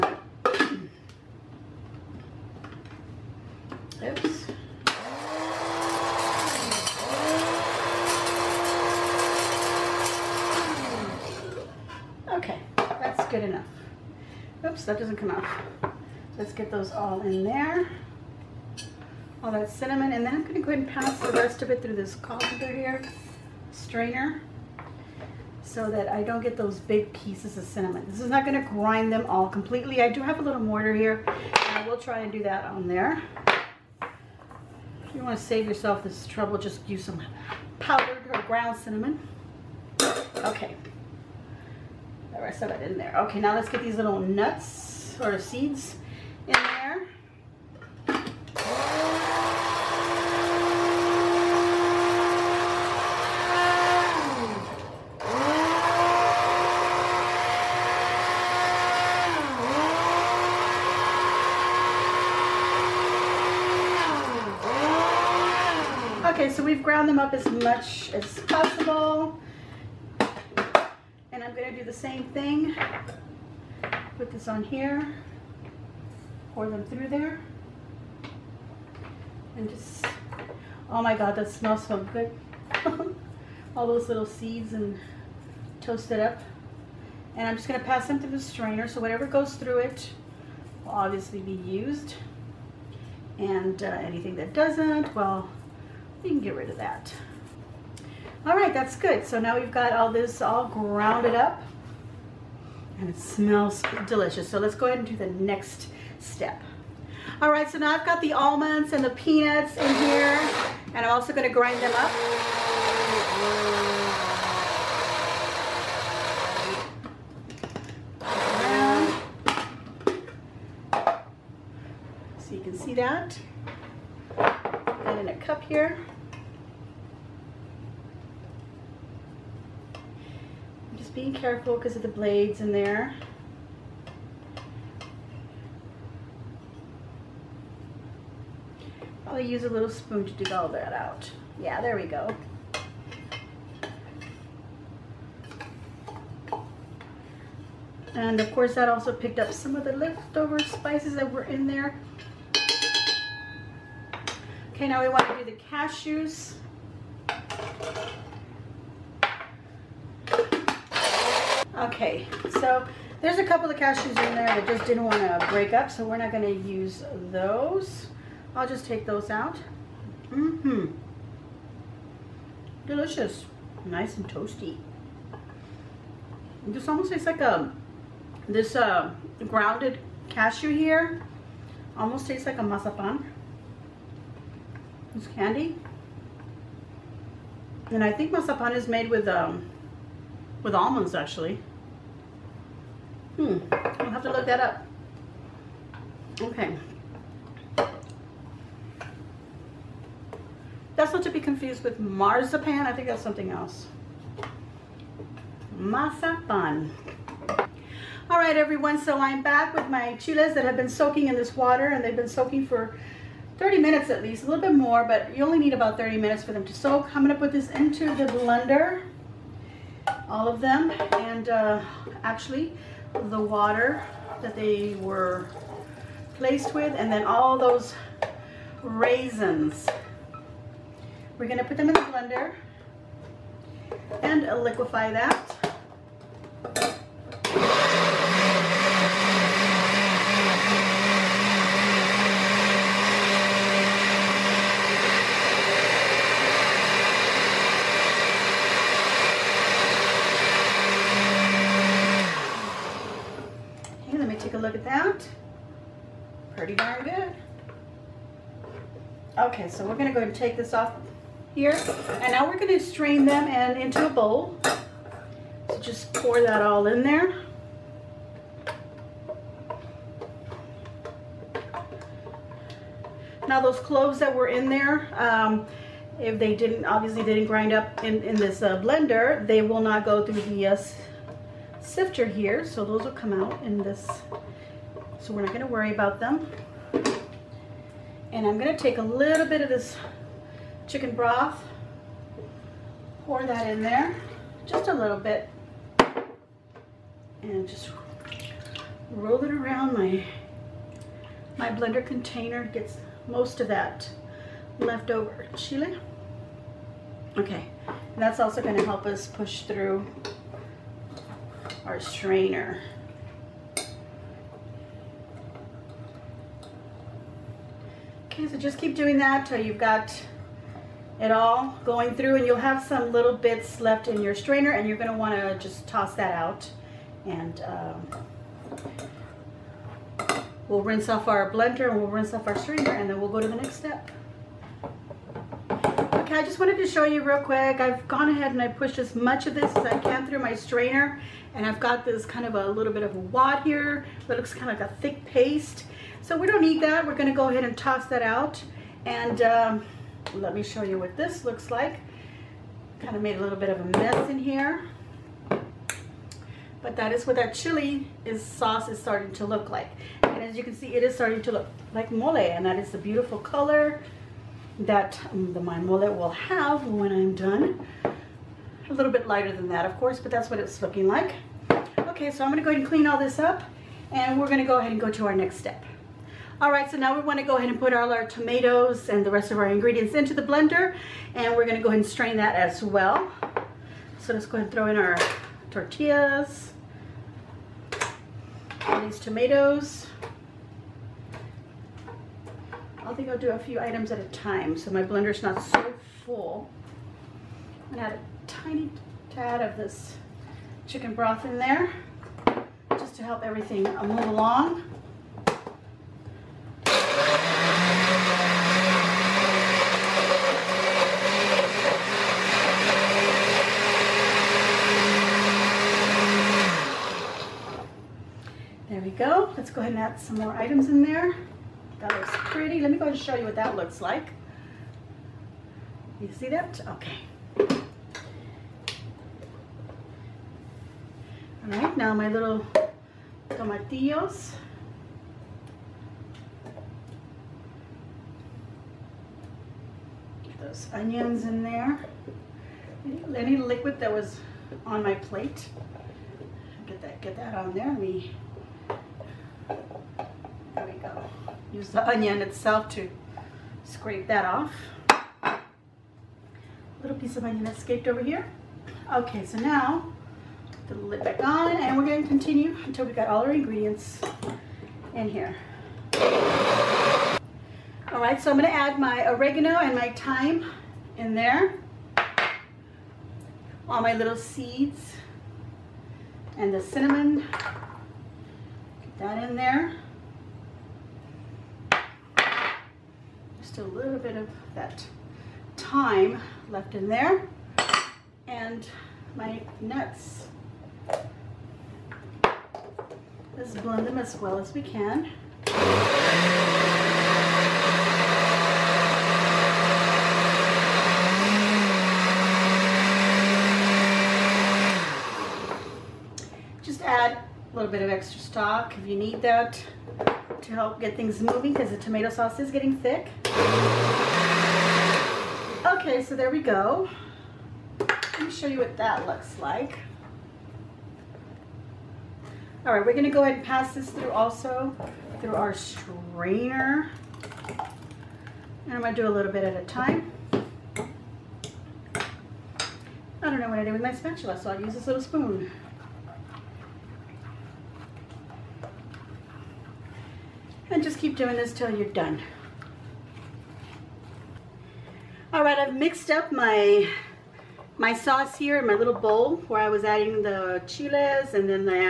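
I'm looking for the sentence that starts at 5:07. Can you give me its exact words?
Okay, and that's also gonna help us push through our strainer.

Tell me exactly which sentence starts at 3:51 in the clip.
We're gonna put them in the blender and liquefy that.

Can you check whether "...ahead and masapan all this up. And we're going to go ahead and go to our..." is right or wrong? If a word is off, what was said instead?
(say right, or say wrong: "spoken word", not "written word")
wrong: "clean", not "masapan".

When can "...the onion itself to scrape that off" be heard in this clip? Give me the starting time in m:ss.
7:31.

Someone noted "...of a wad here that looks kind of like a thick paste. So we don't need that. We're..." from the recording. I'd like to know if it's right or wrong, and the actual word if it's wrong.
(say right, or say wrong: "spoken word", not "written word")
right.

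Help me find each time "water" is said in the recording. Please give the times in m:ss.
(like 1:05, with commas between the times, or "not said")
3:31, 3:43.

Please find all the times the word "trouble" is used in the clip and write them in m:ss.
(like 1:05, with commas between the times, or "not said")
0:36.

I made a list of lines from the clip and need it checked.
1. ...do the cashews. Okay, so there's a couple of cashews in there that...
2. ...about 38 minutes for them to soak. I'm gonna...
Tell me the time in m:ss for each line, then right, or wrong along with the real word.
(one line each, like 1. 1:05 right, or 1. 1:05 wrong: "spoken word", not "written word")
1. 2:35 right
2. 3:35 wrong: "30", not "38".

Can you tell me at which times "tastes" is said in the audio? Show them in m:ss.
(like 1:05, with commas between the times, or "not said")
2:57, 3:02.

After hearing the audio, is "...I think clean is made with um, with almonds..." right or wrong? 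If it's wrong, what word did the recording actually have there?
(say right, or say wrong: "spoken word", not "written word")
wrong: "masapan", not "clean".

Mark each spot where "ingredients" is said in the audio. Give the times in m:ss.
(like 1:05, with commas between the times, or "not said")
6:19, 7:43.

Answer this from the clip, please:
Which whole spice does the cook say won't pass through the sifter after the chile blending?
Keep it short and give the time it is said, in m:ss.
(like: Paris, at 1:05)
cloves, at 4:33.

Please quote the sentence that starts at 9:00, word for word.
And just keep doing this till you're done.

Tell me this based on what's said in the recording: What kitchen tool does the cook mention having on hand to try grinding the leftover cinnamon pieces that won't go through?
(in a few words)
mortar.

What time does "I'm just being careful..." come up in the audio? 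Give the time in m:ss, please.
2:09.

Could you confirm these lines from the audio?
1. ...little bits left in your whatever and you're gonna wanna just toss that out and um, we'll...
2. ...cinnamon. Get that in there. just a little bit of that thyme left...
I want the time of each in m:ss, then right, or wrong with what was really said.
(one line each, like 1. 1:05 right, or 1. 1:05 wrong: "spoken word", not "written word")
1. 5:23 wrong: "strainer", not "whatever"
2. 7:56 right.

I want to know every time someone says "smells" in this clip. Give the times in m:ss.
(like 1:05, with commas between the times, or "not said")
1:21, 1:43.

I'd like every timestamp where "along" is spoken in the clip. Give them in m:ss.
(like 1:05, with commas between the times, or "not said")
6:44.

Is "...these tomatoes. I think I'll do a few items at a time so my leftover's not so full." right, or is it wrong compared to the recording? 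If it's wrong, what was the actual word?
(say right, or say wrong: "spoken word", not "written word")
wrong: "blender", not "leftover".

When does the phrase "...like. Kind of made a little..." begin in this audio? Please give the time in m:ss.
5:51.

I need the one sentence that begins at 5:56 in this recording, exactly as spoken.
But that is what that chili is sauce is starting to look like.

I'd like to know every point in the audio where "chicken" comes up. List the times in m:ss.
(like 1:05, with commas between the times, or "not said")
4:50, 6:40.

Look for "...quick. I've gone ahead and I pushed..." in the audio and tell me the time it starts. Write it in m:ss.
5:37.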